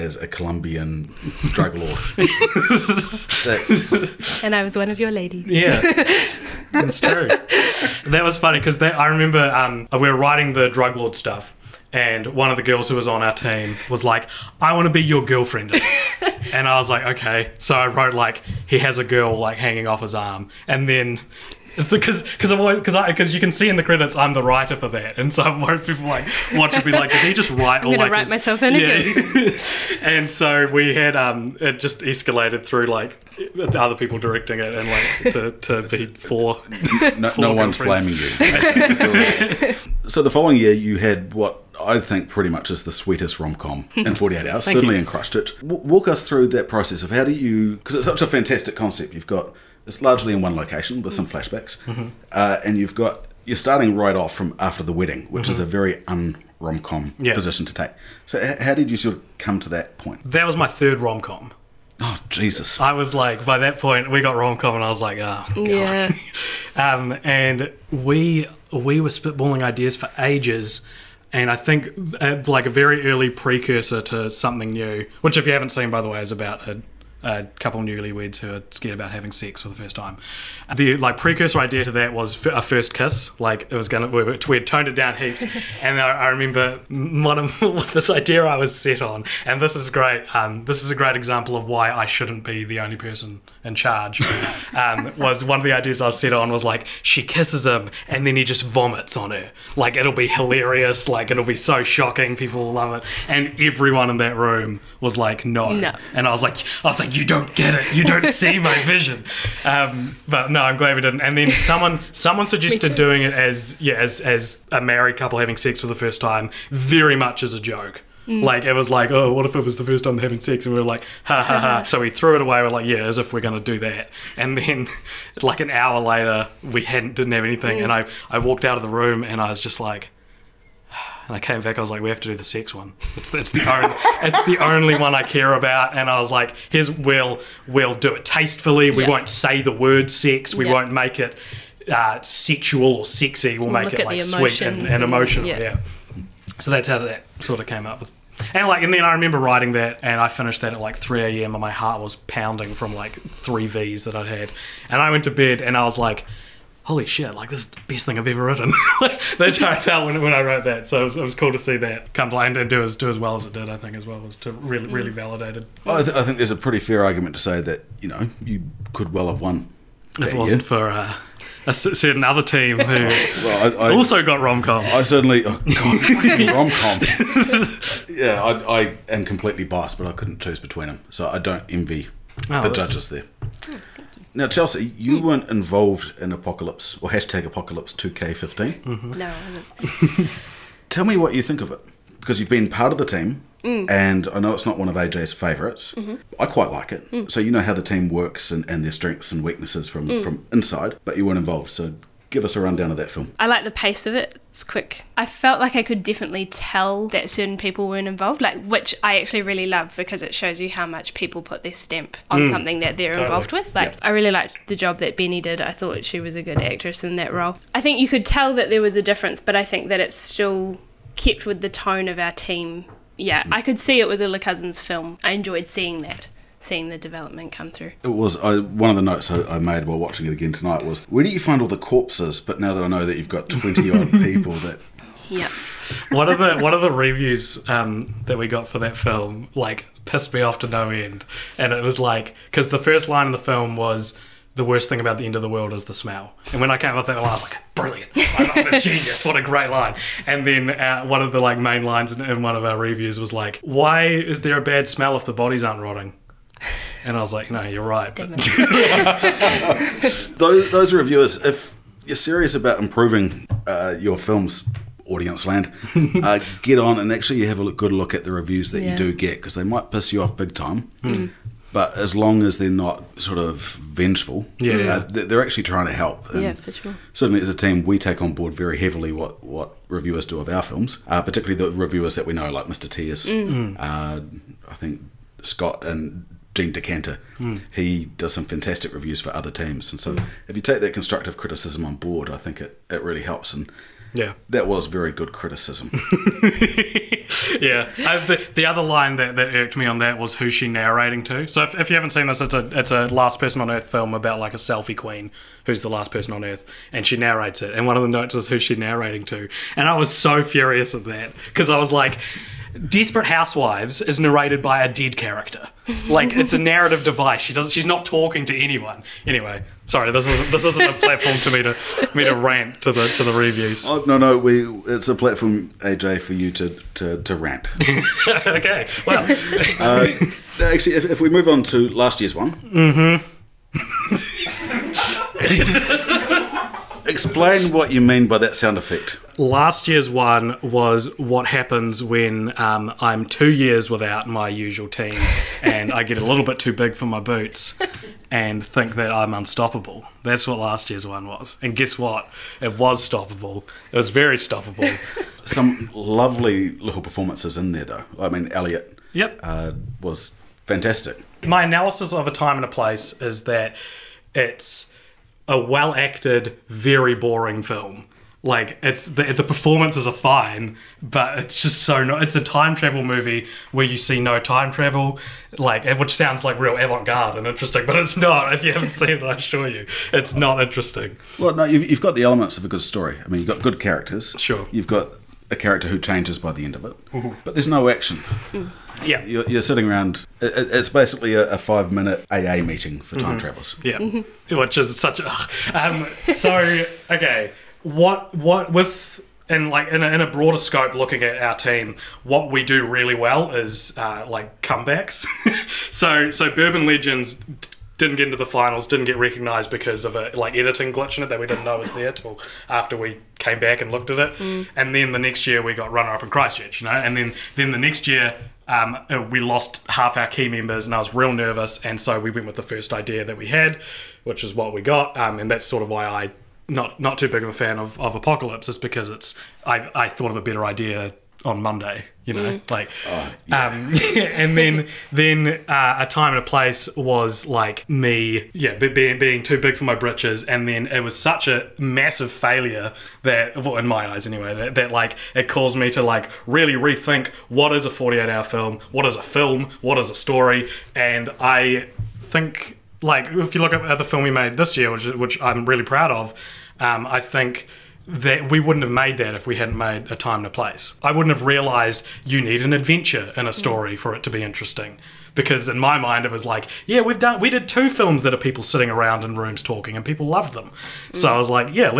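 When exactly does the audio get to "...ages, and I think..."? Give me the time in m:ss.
1:10.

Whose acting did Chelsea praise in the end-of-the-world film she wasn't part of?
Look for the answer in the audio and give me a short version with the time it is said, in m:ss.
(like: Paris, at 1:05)
Benny, at 3:35.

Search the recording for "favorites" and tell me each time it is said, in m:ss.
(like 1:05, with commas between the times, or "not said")
3:15.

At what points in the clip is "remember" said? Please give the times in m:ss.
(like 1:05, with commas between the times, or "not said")
0:09, 1:26, 2:29.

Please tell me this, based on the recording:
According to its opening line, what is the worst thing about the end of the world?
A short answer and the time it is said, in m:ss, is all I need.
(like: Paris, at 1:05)
The smell, at 4:05.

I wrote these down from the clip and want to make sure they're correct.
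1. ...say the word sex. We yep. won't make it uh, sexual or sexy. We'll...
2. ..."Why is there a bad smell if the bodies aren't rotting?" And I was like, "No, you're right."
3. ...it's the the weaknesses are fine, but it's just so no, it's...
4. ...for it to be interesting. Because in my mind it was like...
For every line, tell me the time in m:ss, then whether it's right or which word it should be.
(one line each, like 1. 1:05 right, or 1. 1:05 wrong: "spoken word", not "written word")
1. 2:19 right
2. 4:13 right
3. 6:08 wrong: "performances", not "weaknesses"
4. 7:43 right.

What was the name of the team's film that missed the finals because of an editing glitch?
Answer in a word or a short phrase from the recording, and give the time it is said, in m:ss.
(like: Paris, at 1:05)
Bourbon Legends, at 6:46.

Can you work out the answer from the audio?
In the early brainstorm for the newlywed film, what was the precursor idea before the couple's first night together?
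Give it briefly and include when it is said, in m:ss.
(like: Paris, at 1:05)
A first kiss, at 1:22.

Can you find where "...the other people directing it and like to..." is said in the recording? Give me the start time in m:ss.
0:33.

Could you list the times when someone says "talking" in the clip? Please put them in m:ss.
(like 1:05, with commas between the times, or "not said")
5:18, 7:49.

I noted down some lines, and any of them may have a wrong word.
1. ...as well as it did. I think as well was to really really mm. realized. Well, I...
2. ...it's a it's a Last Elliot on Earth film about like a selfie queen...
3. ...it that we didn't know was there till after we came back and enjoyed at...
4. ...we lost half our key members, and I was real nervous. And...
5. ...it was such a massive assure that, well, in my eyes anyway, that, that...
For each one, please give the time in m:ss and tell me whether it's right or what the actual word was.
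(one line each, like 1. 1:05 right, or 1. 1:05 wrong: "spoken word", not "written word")
1. 2:43 wrong: "validated", not "realized"
2. 5:02 wrong: "Person", not "Elliot"
3. 6:51 wrong: "looked", not "enjoyed"
4. 6:59 right
5. 7:20 wrong: "failure", not "assure".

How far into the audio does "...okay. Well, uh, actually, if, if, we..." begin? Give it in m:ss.
5:28.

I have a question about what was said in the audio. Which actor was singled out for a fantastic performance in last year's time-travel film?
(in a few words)
Elliot.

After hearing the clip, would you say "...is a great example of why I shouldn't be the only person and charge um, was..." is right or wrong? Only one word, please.
right.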